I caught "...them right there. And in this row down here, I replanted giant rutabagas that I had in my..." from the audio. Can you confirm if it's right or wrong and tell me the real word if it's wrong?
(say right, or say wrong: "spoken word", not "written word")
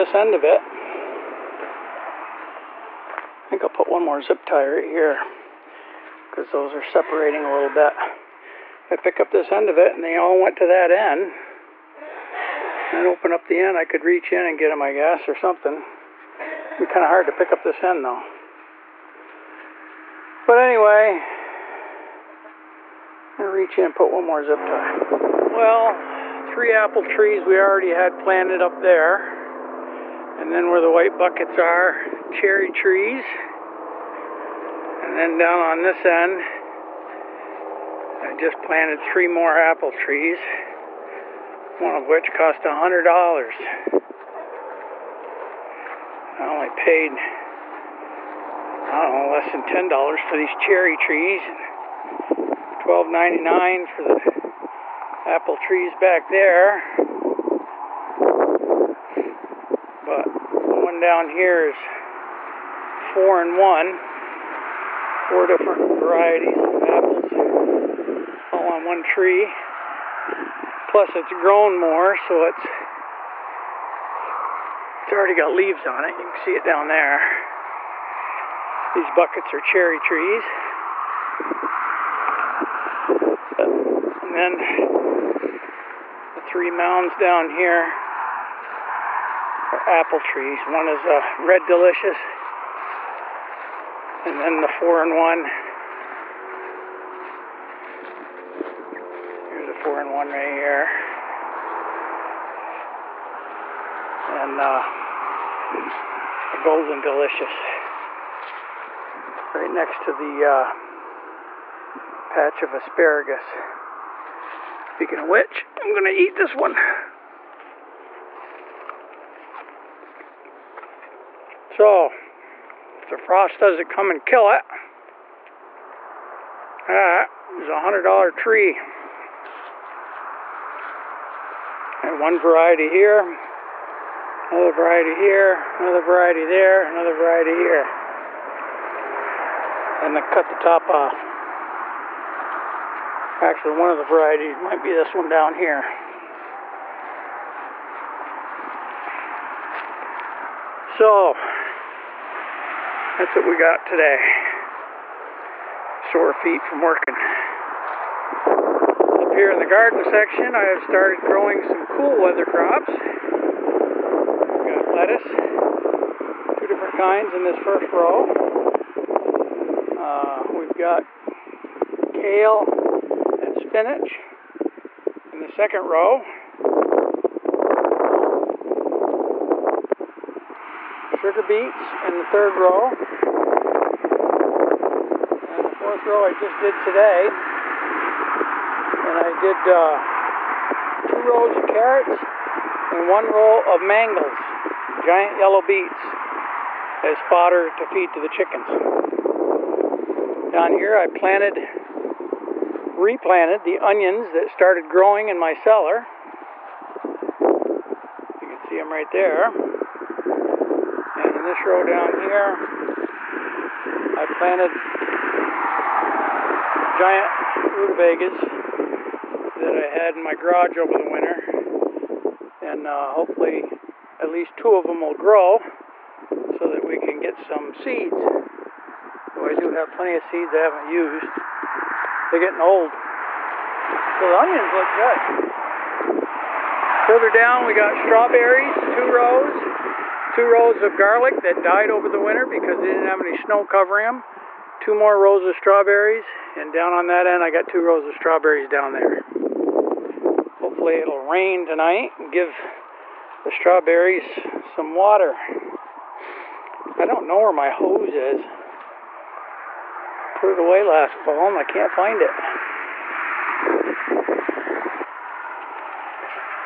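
wrong: "planted", not "replanted".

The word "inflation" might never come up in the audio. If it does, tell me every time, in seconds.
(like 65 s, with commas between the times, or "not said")
not said.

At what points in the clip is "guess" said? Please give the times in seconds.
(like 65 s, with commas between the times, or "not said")
14 s.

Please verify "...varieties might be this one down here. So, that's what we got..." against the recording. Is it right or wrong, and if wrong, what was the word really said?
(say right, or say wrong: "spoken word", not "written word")
right.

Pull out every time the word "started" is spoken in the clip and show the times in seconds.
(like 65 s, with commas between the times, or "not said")
160 s, 204 s.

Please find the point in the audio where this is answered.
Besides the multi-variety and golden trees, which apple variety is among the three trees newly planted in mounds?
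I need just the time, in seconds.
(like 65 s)
91 s.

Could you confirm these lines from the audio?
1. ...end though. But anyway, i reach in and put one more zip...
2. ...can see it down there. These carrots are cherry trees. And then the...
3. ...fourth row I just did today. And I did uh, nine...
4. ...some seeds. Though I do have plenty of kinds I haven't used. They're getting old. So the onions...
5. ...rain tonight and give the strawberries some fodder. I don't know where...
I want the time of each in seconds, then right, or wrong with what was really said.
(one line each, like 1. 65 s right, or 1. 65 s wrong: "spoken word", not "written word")
1. 17 s right
2. 76 s wrong: "buckets", not "carrots"
3. 185 s wrong: "two", not "nine"
4. 227 s wrong: "seeds", not "kinds"
5. 251 s wrong: "water", not "fodder".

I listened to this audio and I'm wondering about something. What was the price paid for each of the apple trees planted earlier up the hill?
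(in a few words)
$12.99.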